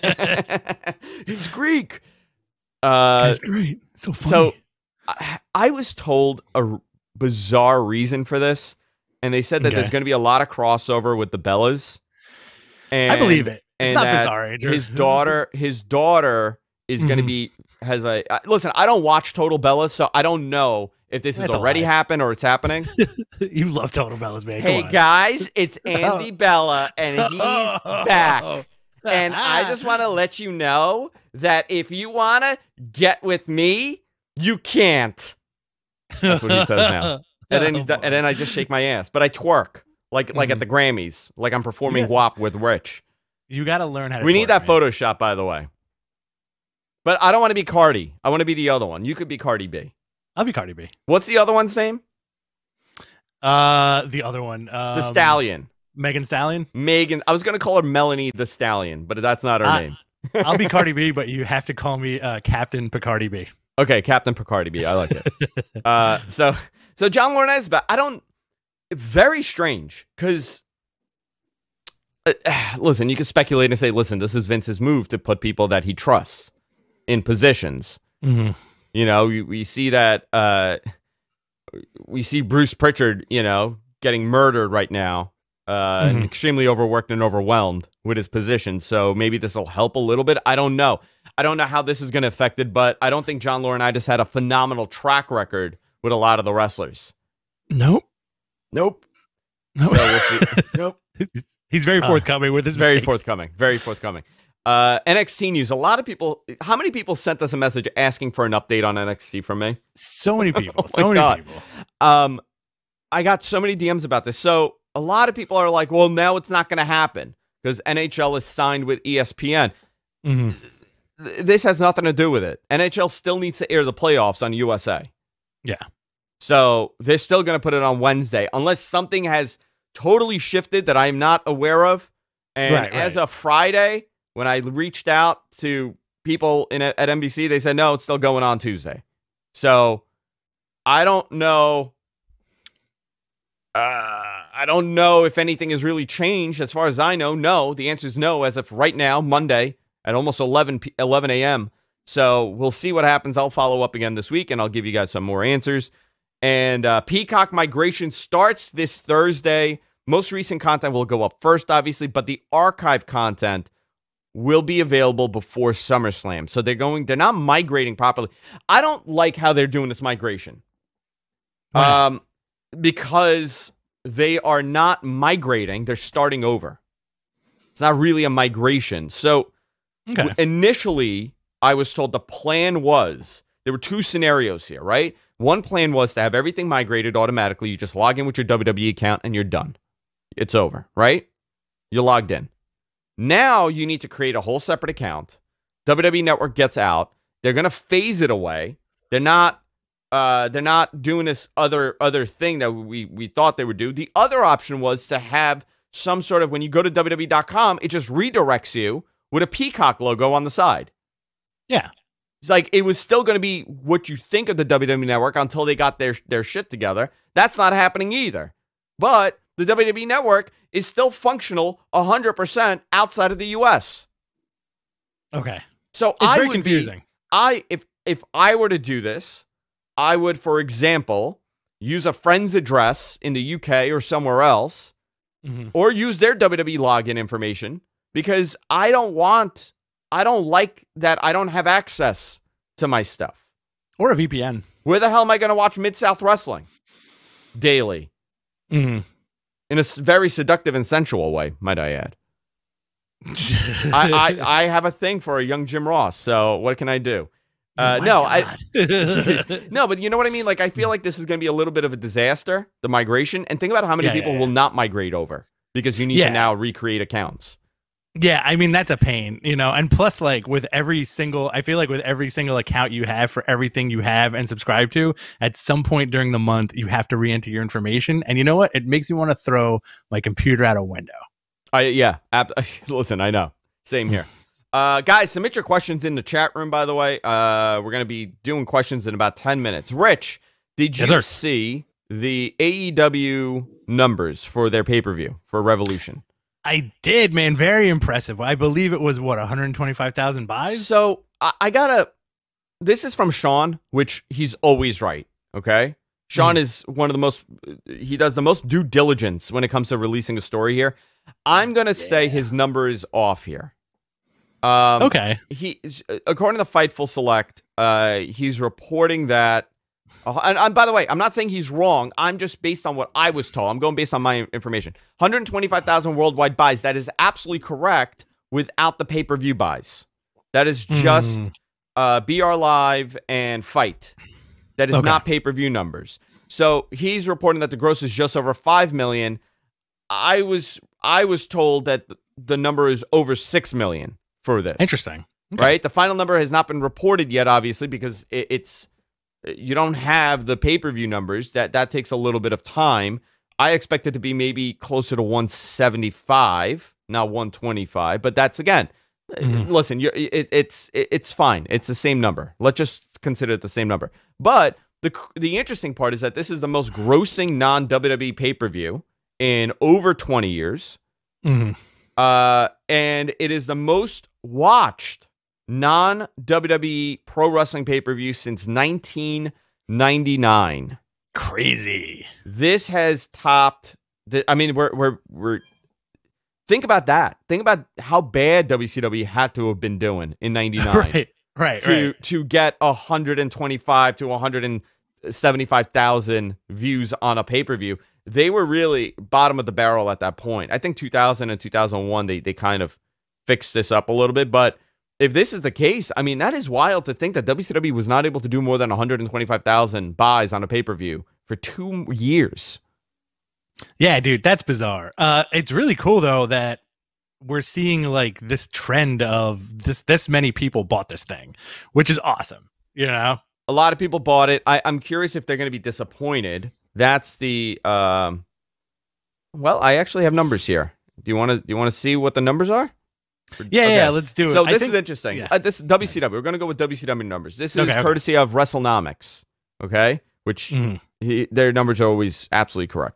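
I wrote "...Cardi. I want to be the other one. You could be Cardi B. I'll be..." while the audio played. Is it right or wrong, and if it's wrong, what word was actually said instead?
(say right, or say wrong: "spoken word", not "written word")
right.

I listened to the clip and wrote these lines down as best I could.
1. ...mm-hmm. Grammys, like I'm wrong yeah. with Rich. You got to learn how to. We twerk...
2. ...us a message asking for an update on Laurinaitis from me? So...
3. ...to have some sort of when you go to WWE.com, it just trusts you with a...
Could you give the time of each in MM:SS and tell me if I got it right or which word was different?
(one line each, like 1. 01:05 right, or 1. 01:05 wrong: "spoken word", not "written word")
1. 00:40 wrong: "performing", not "wrong"
2. 01:47 wrong: "NXT", not "Laurinaitis"
3. 03:25 wrong: "redirects", not "trusts".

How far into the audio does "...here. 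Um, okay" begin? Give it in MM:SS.
05:13.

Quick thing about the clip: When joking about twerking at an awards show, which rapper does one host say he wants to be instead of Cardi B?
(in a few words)
Megan Stallion.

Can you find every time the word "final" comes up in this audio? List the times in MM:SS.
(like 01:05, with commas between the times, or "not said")
05:45.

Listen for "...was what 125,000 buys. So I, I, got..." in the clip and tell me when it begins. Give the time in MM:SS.
04:59.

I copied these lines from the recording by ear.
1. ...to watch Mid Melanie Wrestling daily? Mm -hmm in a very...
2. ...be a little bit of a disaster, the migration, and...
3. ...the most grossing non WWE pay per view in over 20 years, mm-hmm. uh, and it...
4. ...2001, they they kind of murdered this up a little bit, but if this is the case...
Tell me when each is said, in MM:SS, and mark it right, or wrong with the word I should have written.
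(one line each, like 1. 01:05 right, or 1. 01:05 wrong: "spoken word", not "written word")
1. 04:05 wrong: "South", not "Melanie"
2. 04:21 right
3. 06:06 right
4. 06:41 wrong: "fixed", not "murdered".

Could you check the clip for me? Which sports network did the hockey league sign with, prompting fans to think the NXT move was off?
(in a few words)
ESPN.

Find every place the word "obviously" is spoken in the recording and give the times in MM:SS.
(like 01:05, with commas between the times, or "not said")
02:41, 05:47.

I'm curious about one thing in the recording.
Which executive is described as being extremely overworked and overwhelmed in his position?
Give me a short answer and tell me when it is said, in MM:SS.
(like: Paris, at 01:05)
Bruce Pritchard, at 01:22.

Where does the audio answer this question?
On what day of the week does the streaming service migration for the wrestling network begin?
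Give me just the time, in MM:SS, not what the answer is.
02:38.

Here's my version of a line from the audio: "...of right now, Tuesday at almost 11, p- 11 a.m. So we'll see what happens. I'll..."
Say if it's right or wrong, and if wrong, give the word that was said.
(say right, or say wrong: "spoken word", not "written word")
wrong: "Monday", not "Tuesday".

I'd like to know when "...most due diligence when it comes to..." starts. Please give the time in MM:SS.
05:08.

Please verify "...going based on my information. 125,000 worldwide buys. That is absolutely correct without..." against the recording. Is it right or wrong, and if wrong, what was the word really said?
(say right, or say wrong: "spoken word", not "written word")
right.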